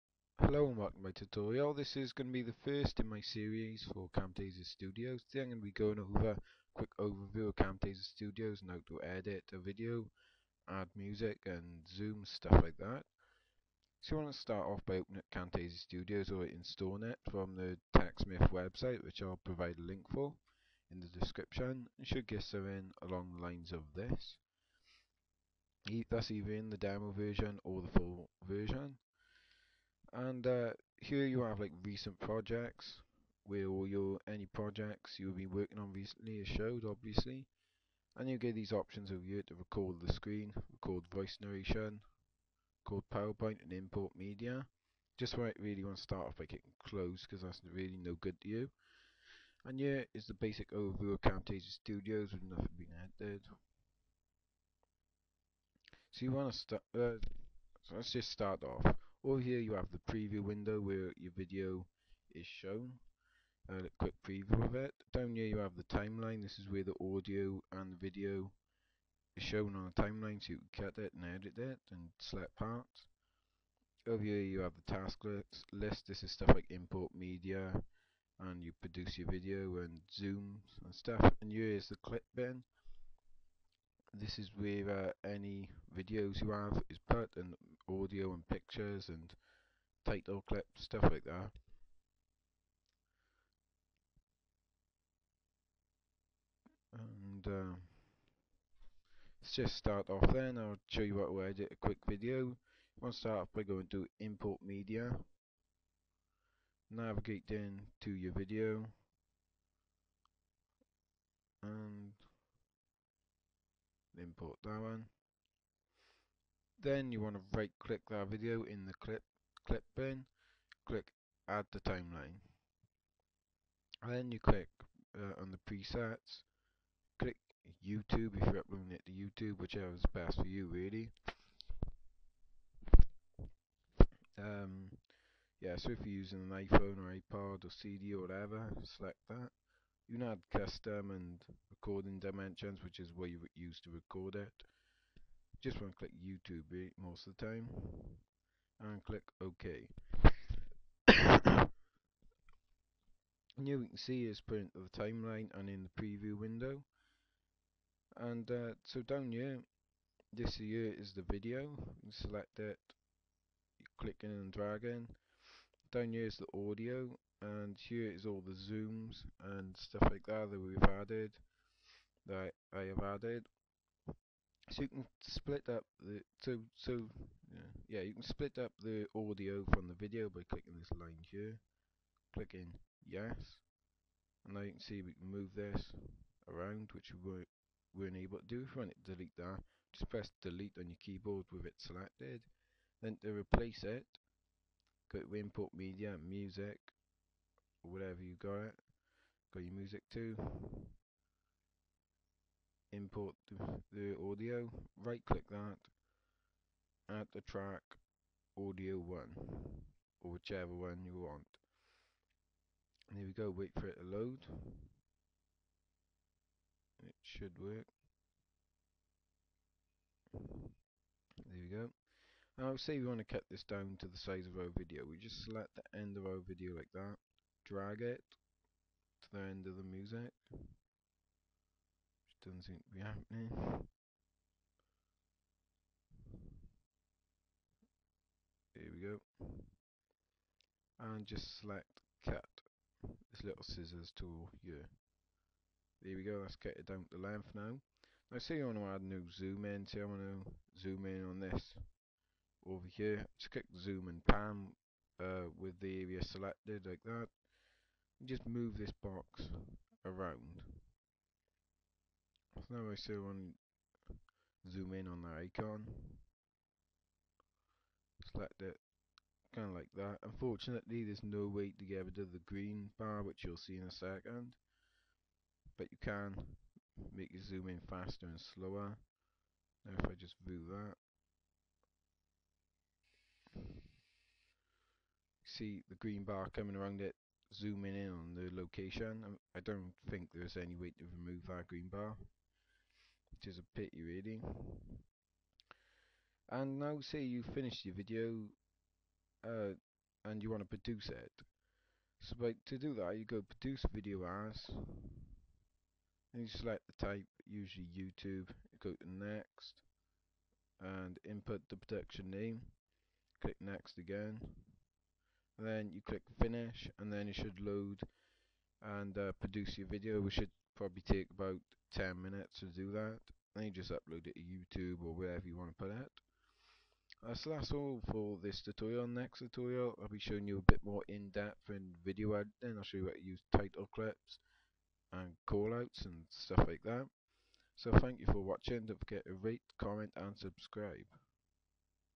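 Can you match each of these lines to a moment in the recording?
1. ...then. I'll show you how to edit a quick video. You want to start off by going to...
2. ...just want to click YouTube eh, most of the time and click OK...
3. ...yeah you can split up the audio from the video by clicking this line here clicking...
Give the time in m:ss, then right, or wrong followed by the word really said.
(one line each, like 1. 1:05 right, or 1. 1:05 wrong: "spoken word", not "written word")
1. 1:40 right
2. 2:25 right
3. 2:57 right.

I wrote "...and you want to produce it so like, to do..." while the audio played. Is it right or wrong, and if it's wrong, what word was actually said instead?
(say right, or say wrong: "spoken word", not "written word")
right.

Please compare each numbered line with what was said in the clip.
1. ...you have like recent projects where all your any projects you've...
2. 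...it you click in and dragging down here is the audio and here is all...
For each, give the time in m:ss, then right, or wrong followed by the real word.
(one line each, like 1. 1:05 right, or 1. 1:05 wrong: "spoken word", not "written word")
1. 0:31 right
2. 2:42 right.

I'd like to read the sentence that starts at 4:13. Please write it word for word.
Just click zoom and pan uh, with the area selected like that.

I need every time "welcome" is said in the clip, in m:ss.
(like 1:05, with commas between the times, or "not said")
0:00.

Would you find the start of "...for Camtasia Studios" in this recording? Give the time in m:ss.
0:03.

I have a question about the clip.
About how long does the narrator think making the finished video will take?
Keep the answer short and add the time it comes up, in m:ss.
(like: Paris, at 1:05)
10 minutes, at 5:21.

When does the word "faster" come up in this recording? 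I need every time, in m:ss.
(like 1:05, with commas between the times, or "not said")
4:37.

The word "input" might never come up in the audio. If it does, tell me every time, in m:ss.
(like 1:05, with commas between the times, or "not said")
3:15, 5:11.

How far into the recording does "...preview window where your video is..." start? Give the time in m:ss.
1:00.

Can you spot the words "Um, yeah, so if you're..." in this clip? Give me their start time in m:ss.
2:14.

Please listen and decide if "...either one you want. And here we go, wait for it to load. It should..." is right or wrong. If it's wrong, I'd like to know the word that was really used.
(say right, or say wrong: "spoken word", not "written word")
wrong: "whichever", not "either".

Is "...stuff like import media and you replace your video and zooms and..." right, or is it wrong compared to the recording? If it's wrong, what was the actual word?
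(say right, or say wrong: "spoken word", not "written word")
wrong: "produce", not "replace".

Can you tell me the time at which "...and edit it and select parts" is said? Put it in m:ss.
1:11.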